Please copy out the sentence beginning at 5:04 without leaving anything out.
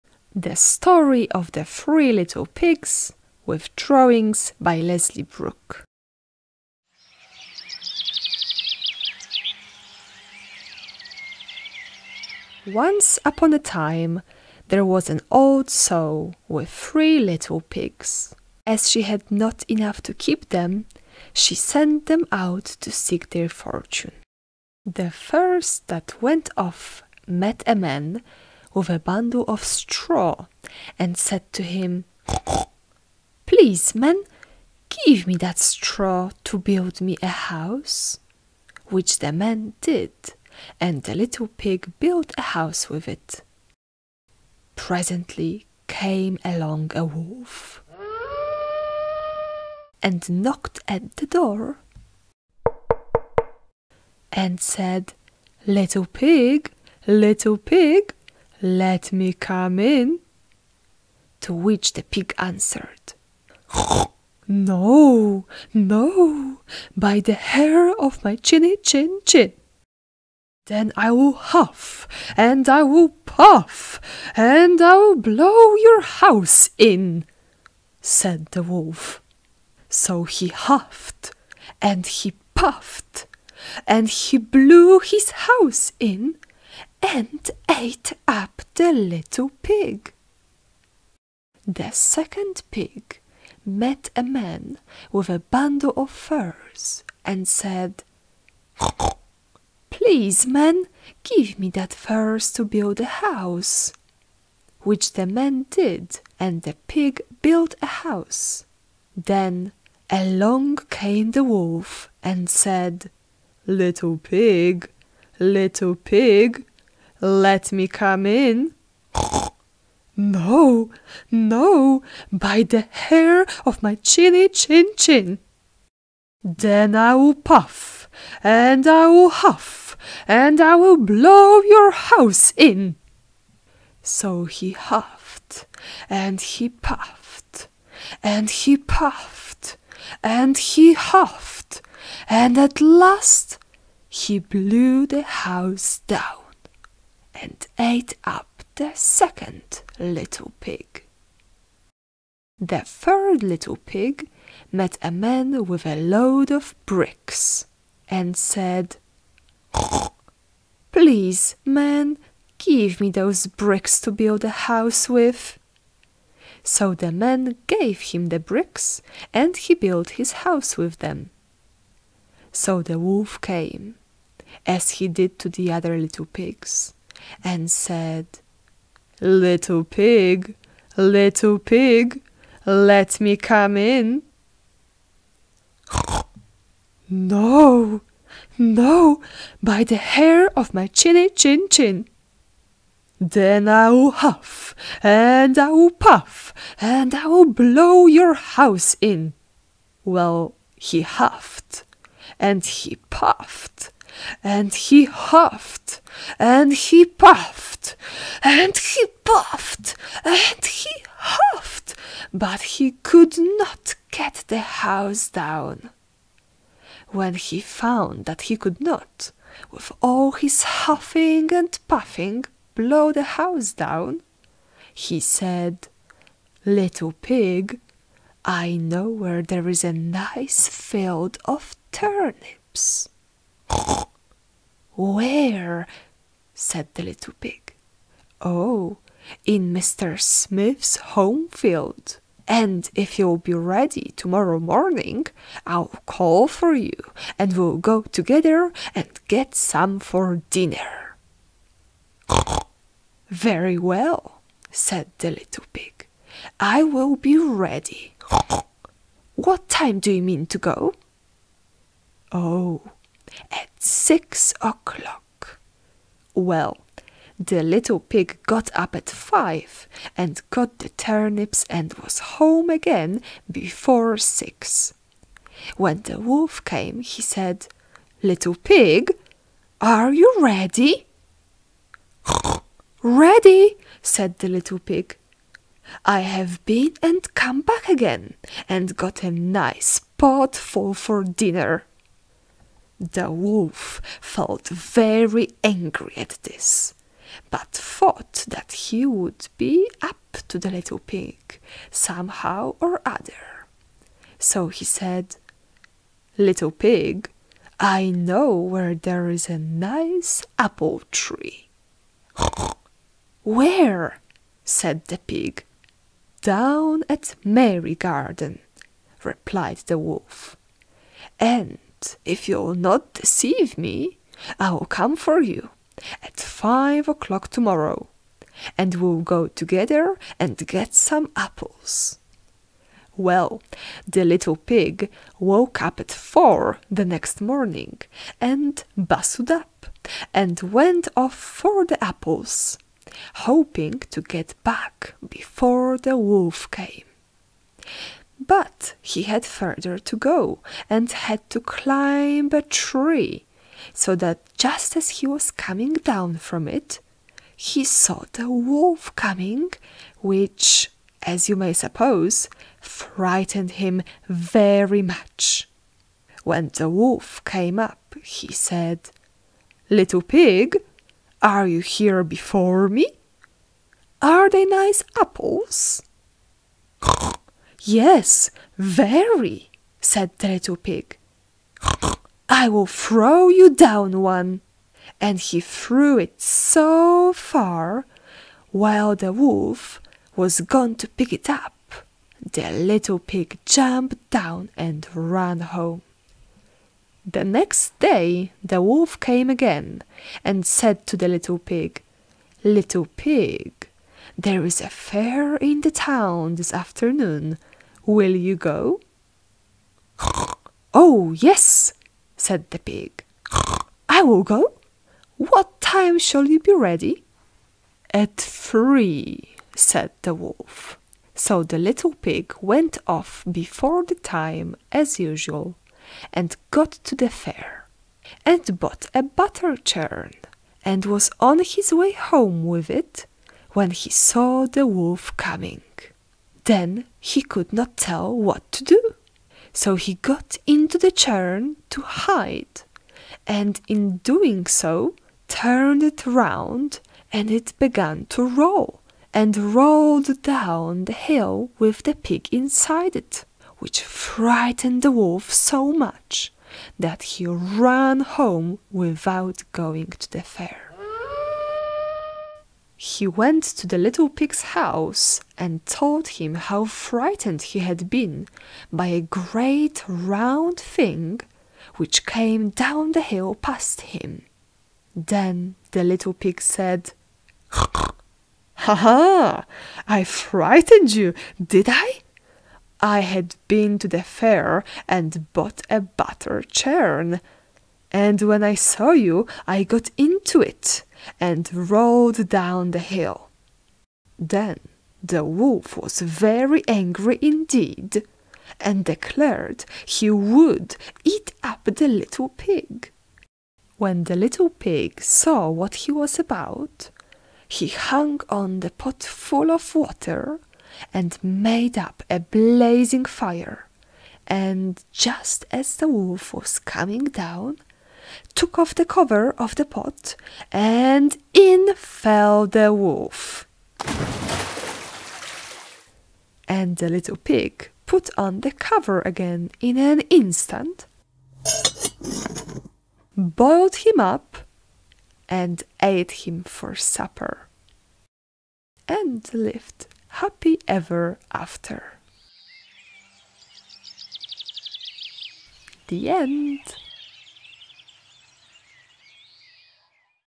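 So he said, Little pig, I know where there is a nice apple tree.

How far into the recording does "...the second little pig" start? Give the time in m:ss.
2:28.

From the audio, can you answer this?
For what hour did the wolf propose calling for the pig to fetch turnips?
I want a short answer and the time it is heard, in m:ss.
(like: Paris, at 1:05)
6 o'clock, at 4:23.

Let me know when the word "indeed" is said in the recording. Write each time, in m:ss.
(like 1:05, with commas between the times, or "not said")
8:17.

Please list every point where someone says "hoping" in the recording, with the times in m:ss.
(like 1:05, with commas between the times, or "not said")
5:43.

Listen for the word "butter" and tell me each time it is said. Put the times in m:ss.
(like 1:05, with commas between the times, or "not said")
7:09, 8:06.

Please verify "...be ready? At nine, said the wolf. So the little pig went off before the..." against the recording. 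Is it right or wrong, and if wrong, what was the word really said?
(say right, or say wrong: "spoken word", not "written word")
wrong: "three", not "nine".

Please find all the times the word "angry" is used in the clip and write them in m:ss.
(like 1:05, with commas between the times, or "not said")
4:55, 8:16.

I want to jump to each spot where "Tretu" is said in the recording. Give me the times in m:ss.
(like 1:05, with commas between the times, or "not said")
6:20.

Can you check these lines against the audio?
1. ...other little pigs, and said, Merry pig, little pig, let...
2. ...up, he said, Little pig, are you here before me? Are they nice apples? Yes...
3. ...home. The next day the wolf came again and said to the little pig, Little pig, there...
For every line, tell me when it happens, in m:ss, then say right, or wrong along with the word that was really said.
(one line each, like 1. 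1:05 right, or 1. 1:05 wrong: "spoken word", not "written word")
1. 2:55 wrong: "Little", not "Merry"
2. 6:07 right
3. 6:35 right.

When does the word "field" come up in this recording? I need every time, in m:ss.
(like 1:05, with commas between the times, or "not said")
3:50, 4:01.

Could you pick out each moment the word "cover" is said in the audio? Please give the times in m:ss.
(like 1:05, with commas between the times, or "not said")
8:39, 8:48.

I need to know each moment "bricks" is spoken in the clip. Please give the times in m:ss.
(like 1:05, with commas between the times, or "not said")
2:36, 2:43, 2:48.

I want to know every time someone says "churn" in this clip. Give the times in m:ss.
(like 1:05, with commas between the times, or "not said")
7:09, 7:21, 8:06.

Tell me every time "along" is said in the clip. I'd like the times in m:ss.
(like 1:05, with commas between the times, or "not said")
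0:46, 1:50.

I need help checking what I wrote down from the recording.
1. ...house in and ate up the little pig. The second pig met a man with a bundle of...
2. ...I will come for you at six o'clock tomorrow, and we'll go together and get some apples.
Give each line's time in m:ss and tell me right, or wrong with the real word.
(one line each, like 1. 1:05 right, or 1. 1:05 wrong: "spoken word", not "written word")
1. 1:25 right
2. 5:24 wrong: "five", not "six".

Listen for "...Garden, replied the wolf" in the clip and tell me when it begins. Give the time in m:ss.
5:17.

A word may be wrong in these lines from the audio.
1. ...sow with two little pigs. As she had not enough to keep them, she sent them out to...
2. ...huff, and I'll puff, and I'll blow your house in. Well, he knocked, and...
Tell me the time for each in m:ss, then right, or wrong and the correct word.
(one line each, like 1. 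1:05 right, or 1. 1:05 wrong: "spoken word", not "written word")
1. 0:15 wrong: "three", not "two"
2. 3:14 wrong: "huffed", not "knocked".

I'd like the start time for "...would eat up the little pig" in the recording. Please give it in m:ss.
8:20.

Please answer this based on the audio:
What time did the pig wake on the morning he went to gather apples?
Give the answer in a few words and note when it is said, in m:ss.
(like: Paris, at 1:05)
4, at 5:36.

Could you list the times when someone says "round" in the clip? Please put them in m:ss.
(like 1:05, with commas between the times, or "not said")
7:26, 7:50.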